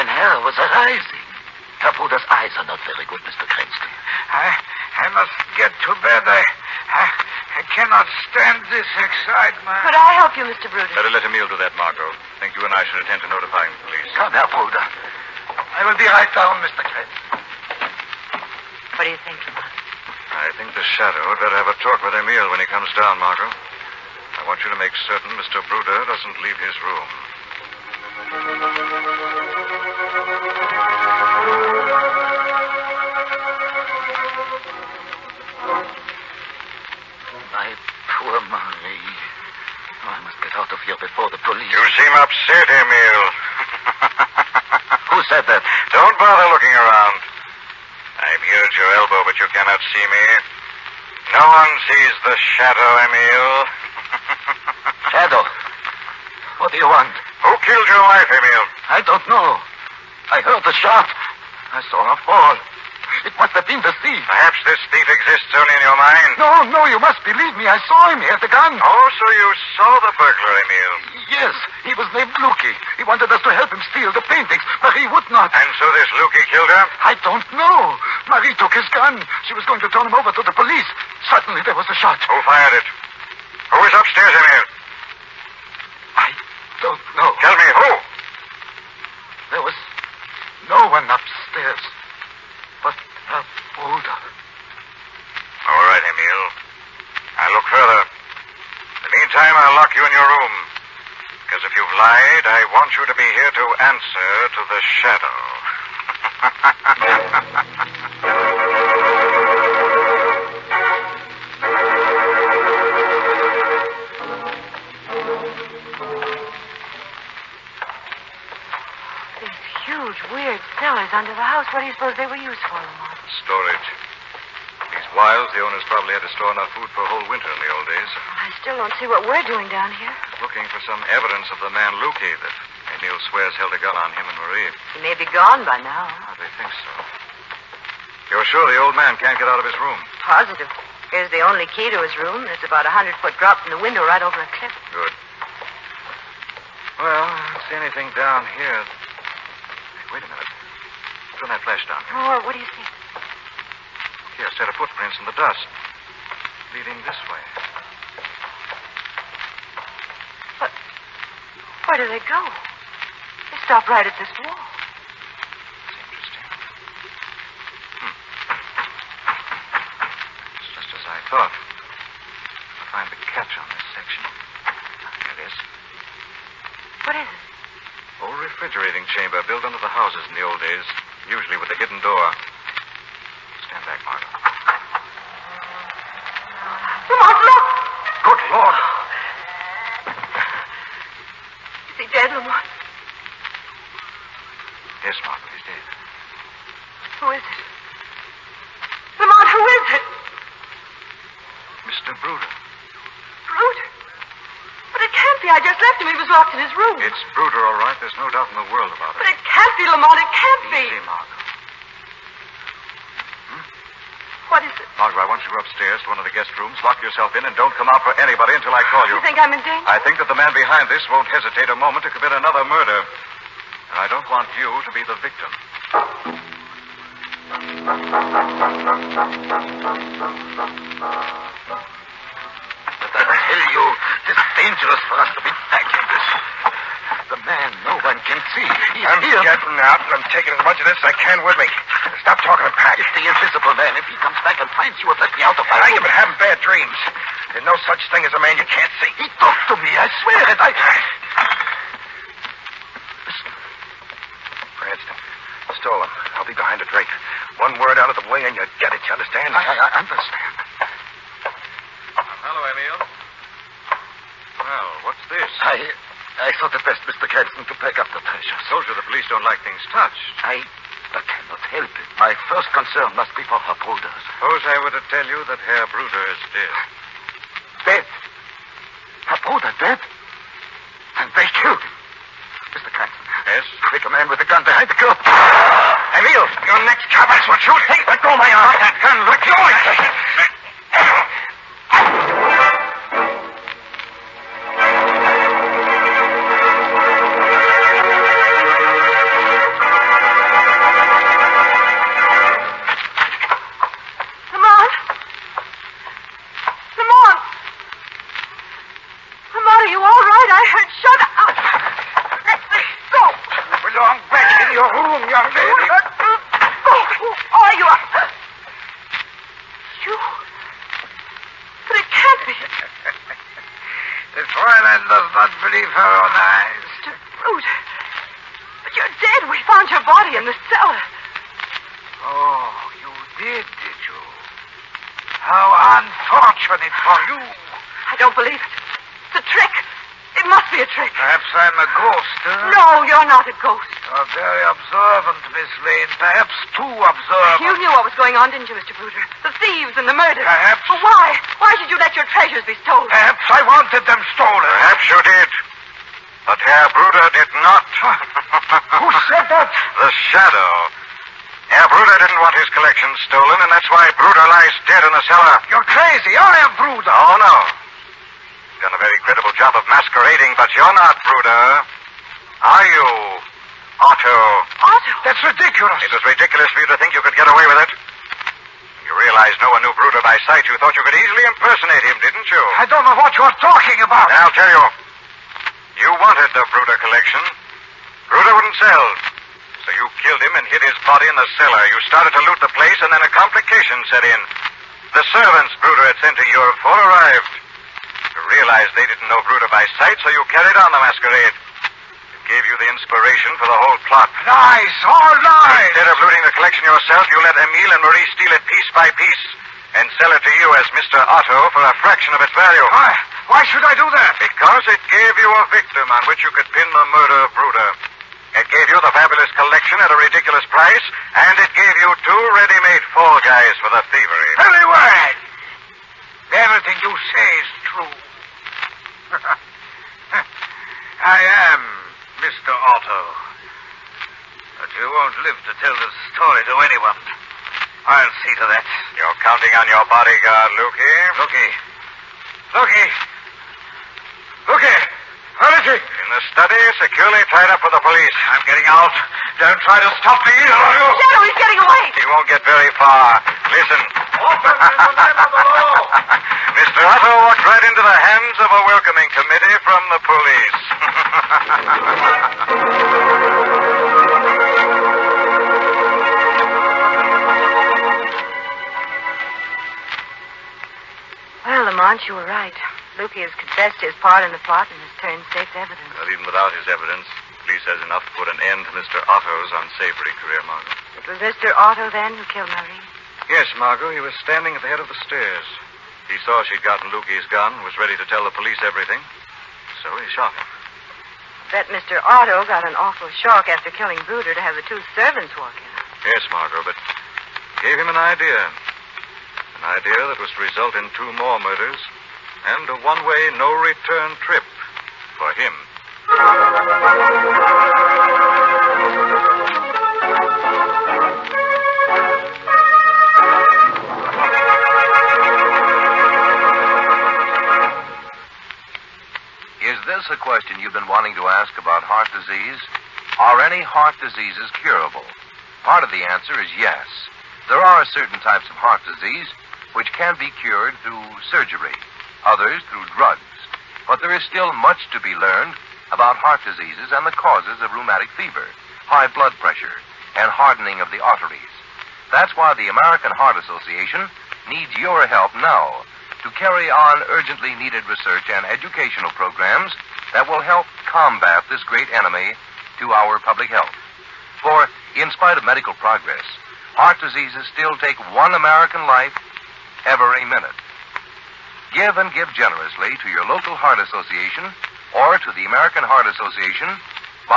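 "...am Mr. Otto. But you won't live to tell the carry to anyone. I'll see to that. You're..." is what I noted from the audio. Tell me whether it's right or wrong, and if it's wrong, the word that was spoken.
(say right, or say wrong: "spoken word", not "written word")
wrong: "story", not "carry".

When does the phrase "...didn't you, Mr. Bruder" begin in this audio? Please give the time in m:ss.
5:48.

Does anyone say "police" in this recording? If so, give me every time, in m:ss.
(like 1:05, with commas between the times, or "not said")
0:13, 0:41, 1:20, 4:29, 7:28, 7:40, 7:57, 8:08.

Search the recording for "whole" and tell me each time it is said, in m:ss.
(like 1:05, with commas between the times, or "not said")
2:07, 6:43.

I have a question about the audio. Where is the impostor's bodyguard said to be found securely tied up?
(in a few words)
The study.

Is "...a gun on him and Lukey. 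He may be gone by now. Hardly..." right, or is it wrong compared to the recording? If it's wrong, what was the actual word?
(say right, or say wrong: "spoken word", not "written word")
wrong: "Marie", not "Lukey".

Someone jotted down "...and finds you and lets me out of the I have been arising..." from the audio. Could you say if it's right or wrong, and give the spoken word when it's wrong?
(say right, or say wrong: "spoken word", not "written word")
wrong: "having", not "arising".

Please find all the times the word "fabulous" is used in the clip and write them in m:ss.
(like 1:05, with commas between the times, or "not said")
6:59.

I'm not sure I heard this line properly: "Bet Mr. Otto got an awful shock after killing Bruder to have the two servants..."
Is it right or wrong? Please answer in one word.
right.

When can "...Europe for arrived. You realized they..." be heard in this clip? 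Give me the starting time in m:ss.
6:36.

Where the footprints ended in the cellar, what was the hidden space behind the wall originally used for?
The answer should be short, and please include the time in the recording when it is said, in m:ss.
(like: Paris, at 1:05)
Refrigerating chamber, at 2:58.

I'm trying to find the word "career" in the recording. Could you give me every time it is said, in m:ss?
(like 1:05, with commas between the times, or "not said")
8:00.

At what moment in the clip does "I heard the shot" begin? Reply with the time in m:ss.
1:00.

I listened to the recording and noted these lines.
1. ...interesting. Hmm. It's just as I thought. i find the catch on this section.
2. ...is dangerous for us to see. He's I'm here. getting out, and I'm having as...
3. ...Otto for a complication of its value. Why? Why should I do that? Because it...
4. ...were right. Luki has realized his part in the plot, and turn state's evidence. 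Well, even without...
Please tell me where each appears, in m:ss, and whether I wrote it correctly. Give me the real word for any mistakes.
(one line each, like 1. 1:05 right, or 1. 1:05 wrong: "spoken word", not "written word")
1. 2:46 right
2. 3:54 wrong: "taking", not "having"
3. 6:51 wrong: "fraction", not "complication"
4. 7:52 wrong: "confessed", not "realized".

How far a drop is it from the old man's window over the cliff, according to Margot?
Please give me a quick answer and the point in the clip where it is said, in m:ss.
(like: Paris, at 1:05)
100 feet, at 2:22.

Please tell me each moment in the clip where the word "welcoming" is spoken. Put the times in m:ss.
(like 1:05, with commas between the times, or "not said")
7:38.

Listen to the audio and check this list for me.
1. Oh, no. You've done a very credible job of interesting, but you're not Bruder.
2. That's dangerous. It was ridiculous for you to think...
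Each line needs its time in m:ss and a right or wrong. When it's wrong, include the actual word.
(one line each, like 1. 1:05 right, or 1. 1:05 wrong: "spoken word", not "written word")
1. 6:07 wrong: "masquerading", not "interesting"
2. 6:15 wrong: "ridiculous", not "dangerous".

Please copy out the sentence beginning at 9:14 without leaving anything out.
For, in spite of medical progress, heart diseases still take one American life every minute.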